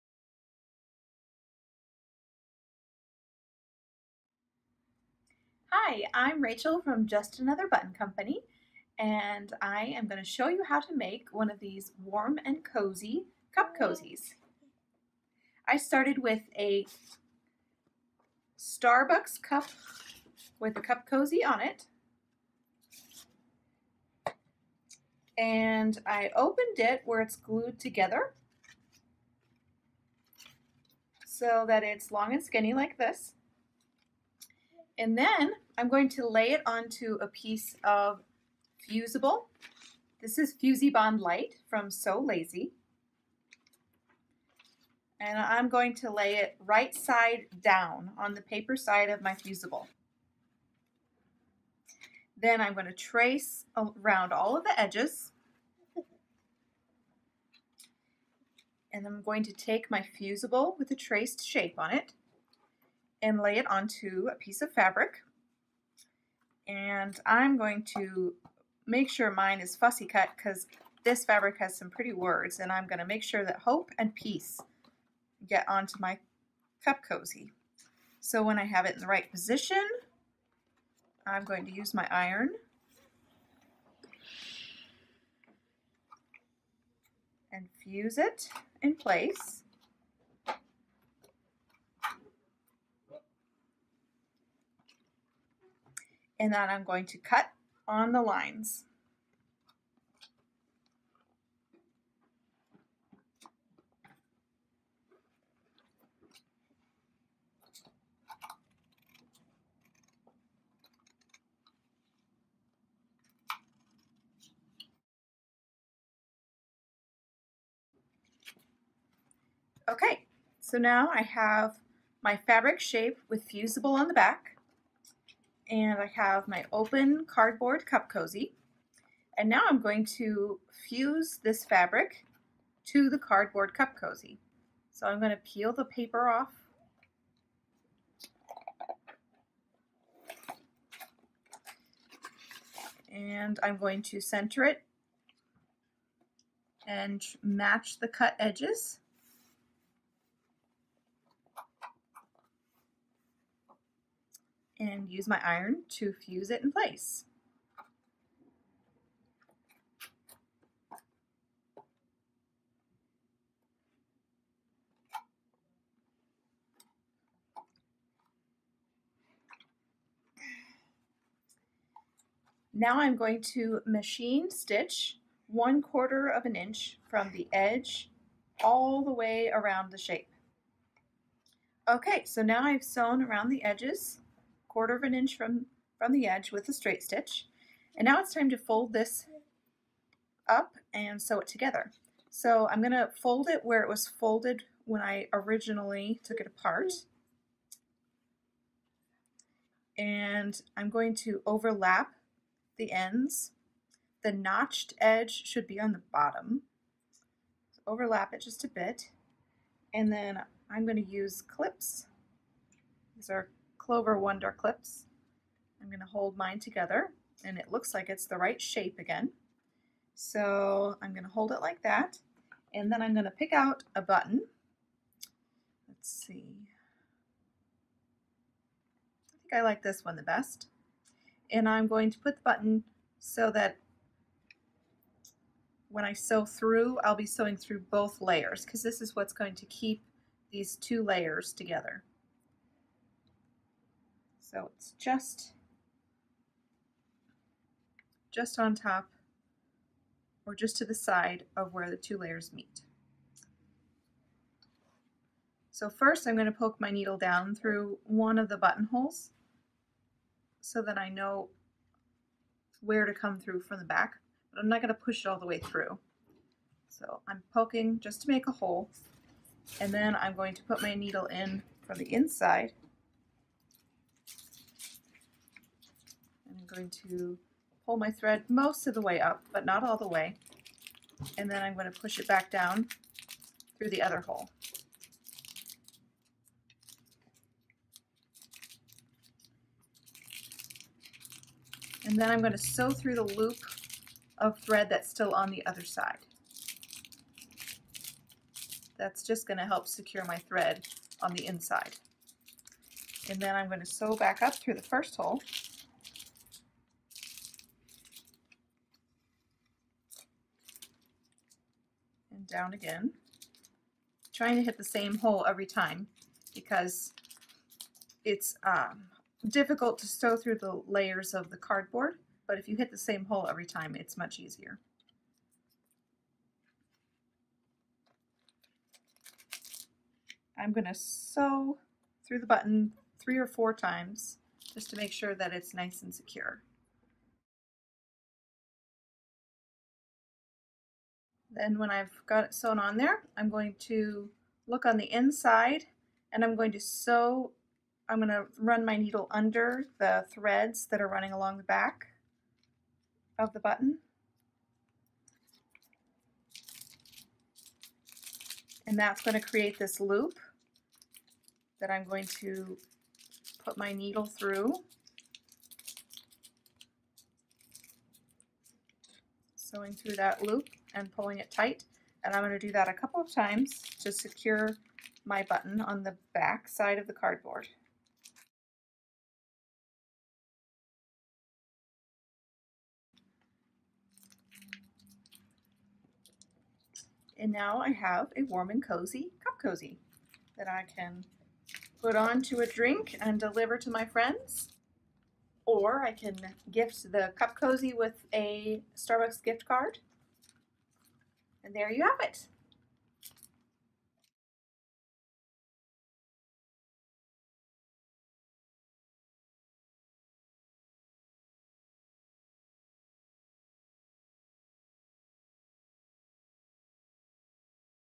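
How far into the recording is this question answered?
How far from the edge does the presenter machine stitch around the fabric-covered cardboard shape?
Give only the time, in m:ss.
2:55.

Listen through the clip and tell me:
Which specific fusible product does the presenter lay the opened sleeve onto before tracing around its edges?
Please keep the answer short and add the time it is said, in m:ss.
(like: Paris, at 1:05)
Fusibond Light, at 0:40.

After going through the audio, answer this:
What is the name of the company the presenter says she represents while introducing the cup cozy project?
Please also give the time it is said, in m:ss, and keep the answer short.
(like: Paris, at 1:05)
Just Another Button Company, at 0:07.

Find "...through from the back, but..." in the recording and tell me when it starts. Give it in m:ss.
4:23.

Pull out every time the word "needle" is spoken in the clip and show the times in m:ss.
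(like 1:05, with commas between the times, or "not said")
4:16, 4:30, 5:48, 6:03.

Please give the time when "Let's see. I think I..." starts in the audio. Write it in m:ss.
3:45.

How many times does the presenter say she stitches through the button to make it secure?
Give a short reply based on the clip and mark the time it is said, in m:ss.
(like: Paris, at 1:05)
3 or 4, at 5:33.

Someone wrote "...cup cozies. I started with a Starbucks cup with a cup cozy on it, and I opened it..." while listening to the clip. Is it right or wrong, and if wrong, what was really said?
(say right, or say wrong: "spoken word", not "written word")
right.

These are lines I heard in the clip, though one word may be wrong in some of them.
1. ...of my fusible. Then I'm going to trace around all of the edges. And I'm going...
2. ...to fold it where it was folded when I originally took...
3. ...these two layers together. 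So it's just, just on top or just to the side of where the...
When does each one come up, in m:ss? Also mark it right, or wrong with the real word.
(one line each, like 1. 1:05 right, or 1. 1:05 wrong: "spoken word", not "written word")
1. 0:49 right
2. 3:12 right
3. 4:00 right.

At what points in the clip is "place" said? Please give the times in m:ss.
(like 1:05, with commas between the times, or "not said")
1:28, 2:36.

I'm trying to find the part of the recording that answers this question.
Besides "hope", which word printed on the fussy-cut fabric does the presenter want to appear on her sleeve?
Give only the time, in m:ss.
1:14.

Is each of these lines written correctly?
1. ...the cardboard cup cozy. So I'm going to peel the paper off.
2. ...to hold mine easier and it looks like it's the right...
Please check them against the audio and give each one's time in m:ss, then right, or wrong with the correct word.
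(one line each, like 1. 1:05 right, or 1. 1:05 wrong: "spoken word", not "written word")
1. 2:13 right
2. 3:35 wrong: "together", not "easier".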